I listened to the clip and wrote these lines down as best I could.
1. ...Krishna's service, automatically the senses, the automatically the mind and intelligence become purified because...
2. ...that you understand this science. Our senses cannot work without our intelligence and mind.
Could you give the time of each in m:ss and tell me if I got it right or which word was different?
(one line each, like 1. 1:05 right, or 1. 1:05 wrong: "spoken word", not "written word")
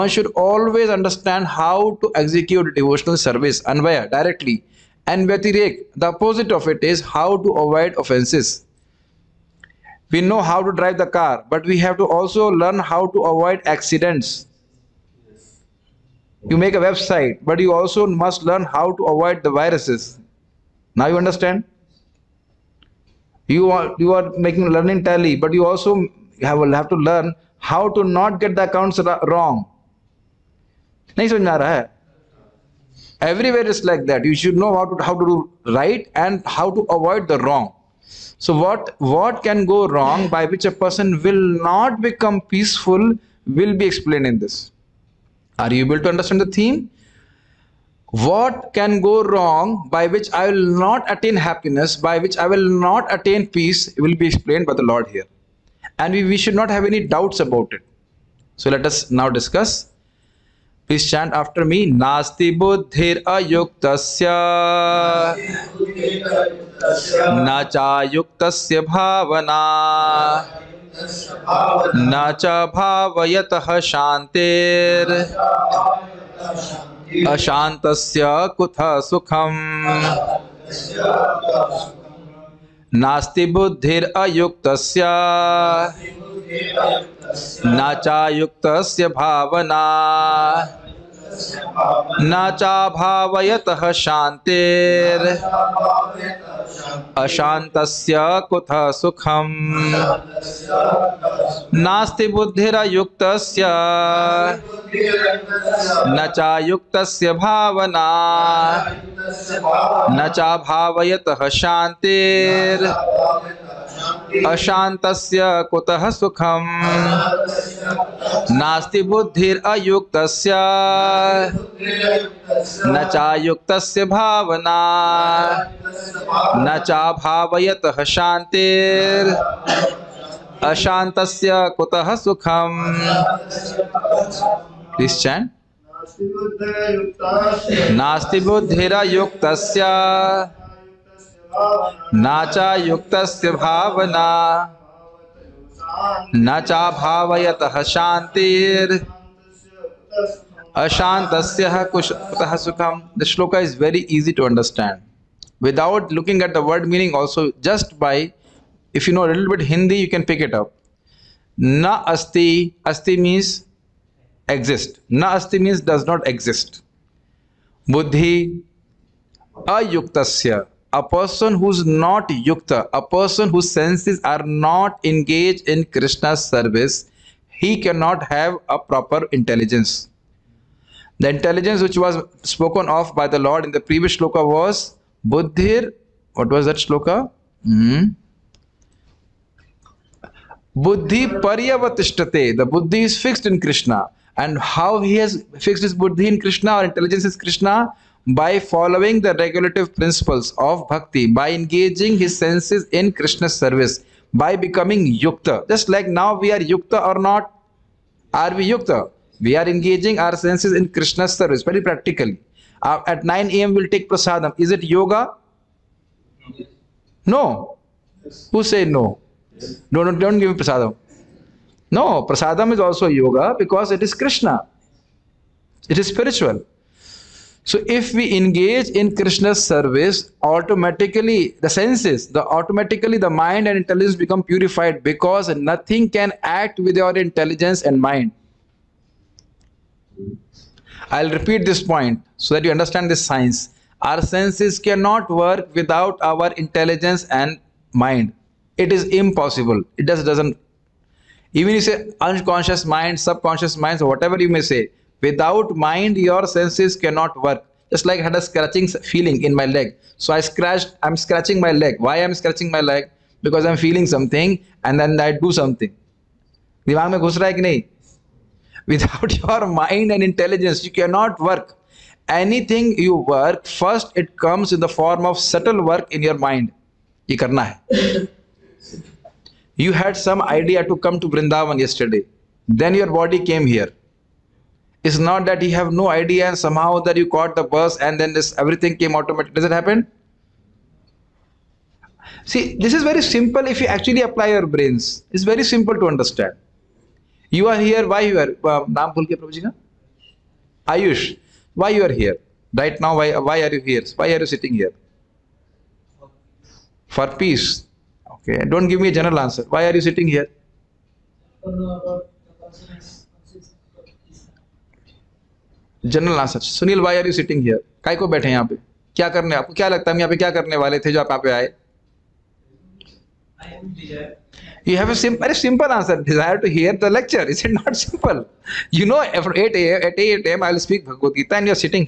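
1. 3:49 right
2. 4:02 right.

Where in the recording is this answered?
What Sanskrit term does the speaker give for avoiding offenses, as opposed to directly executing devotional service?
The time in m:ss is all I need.
0:05.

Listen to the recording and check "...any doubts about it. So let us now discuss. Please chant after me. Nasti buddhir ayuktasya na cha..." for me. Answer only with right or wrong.
right.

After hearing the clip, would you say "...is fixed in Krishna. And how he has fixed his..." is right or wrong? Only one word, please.
right.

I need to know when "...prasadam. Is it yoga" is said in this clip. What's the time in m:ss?
3:34.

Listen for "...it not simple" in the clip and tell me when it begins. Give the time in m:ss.
5:27.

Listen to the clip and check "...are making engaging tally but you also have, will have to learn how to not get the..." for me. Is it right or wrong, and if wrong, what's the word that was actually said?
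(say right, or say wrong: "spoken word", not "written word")
wrong: "learning", not "engaging".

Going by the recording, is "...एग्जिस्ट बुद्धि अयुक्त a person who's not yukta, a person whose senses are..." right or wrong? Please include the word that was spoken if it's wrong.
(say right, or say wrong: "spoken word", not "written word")
right.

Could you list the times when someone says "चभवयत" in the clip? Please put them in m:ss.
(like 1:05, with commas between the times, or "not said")
1:32, 1:50, 2:06.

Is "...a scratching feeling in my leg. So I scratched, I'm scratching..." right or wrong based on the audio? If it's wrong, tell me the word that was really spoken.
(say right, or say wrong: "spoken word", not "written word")
right.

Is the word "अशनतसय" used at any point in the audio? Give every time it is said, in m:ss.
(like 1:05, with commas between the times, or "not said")
1:17, 1:37, 1:54, 2:10.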